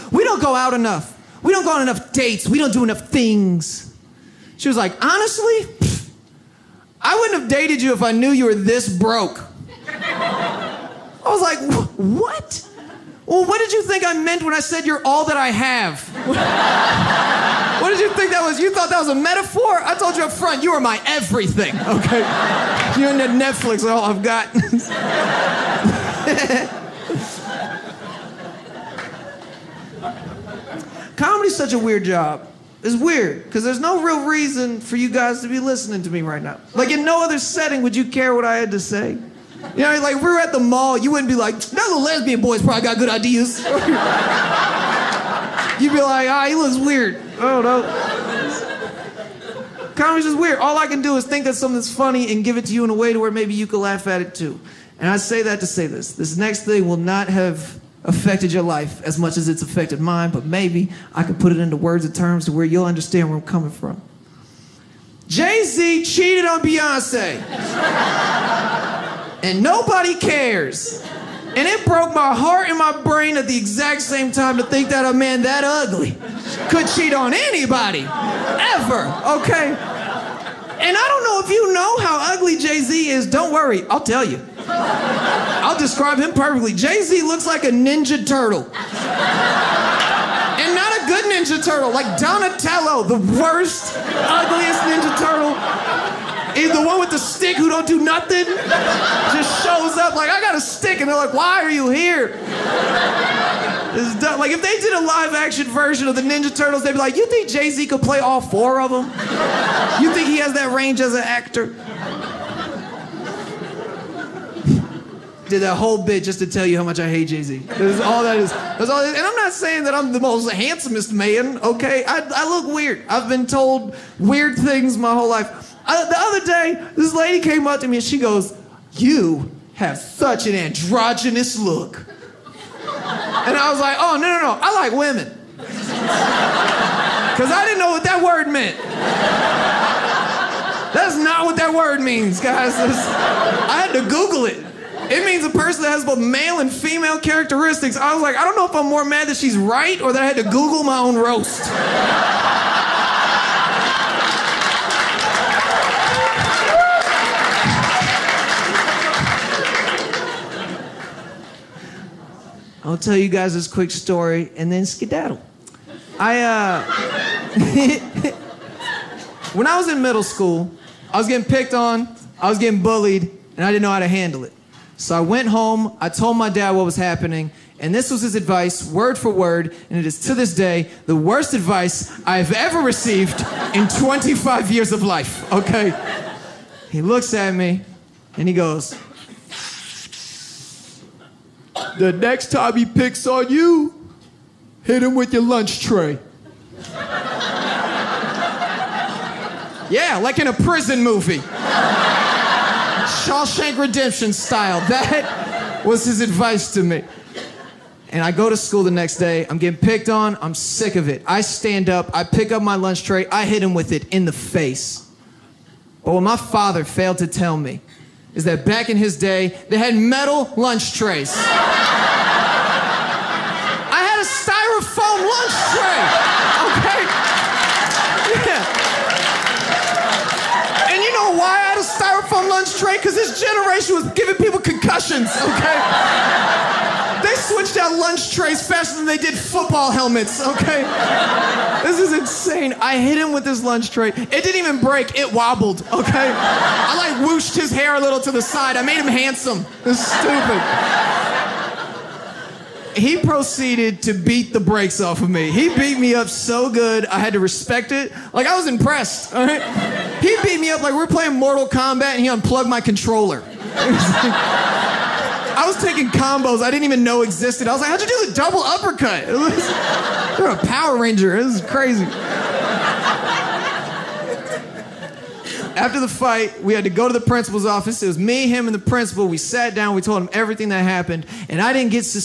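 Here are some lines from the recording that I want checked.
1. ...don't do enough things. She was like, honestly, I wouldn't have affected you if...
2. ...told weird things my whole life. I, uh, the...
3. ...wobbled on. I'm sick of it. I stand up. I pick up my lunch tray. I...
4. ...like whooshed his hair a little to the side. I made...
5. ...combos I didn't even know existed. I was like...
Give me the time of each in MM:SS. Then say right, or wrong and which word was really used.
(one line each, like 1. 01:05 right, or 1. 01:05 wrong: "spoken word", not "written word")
1. 00:02 wrong: "dated", not "affected"
2. 02:03 right
3. 03:29 wrong: "picked", not "wobbled"
4. 04:06 right
5. 04:26 right.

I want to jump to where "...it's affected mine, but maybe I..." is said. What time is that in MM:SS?
00:59.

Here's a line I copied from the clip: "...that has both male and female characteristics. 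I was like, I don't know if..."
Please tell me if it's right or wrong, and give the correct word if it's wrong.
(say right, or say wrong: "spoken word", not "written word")
right.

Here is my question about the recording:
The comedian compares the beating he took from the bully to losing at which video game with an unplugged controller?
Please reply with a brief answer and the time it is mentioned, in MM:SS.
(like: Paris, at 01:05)
Mortal Kombat, at 04:21.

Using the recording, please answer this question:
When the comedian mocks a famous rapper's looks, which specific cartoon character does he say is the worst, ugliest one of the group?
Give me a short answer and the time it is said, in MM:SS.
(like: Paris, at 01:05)
Donatello, at 01:32.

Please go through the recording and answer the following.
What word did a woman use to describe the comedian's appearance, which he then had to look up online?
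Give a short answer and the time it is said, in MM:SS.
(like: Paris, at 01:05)
androgynous, at 02:10.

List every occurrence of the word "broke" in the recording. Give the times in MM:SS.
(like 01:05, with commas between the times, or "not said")
00:08, 01:11.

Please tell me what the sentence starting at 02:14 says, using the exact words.
I like women," because I didn't know what that word meant.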